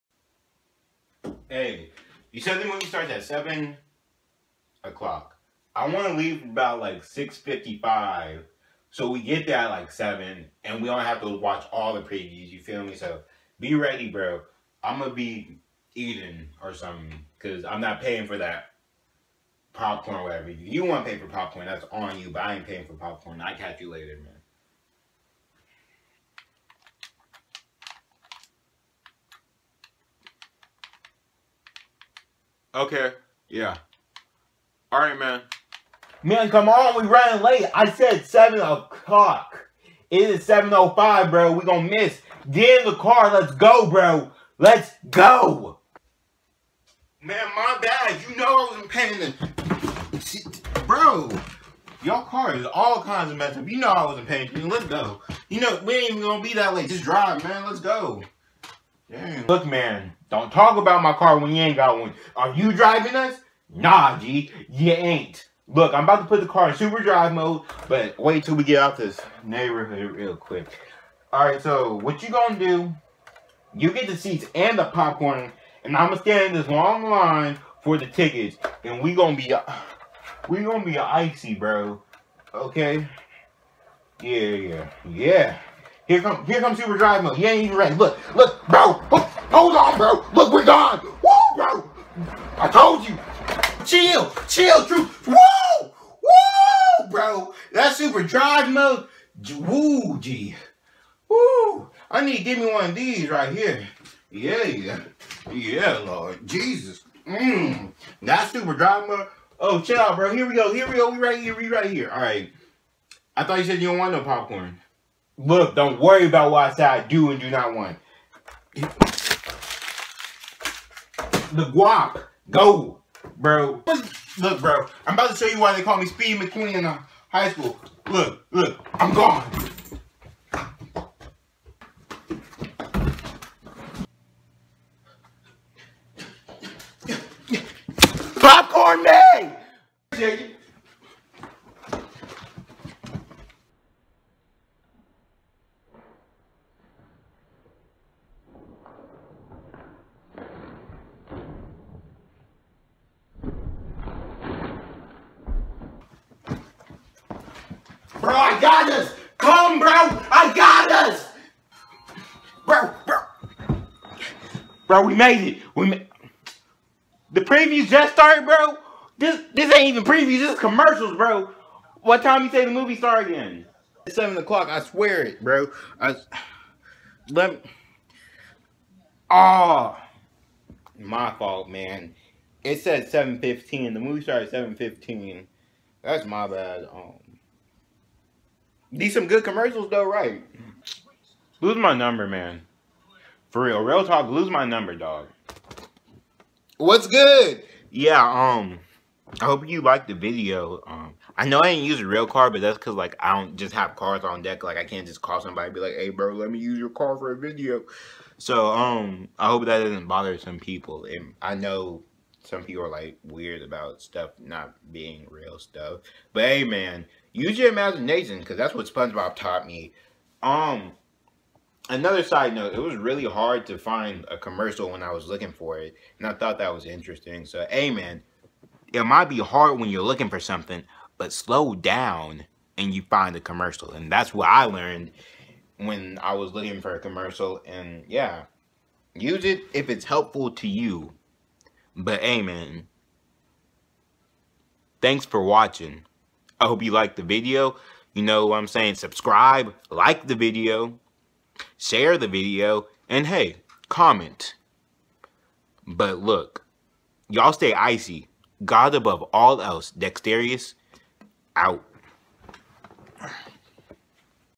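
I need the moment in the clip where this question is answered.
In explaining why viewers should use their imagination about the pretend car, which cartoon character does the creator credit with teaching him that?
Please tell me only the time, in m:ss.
3:38.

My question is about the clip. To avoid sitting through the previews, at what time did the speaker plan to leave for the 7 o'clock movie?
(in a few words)
6:55.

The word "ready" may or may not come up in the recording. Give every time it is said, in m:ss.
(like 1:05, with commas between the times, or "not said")
0:13, 1:27.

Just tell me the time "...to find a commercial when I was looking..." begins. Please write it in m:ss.
3:43.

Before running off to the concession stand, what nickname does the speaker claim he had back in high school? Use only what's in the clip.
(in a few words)
Speed McQueen.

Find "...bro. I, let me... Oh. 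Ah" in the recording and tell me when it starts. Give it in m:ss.
2:55.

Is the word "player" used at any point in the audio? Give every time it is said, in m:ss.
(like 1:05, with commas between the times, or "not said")
not said.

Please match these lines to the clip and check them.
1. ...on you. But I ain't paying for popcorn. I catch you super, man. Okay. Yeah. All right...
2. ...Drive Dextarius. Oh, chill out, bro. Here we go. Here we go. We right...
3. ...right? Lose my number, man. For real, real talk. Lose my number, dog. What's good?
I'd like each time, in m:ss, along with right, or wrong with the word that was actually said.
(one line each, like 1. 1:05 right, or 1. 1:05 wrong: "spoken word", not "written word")
1. 0:21 wrong: "later", not "super"
2. 1:48 wrong: "Mode", not "Dextarius"
3. 3:10 right.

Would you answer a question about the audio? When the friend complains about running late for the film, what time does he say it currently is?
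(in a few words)
7:05.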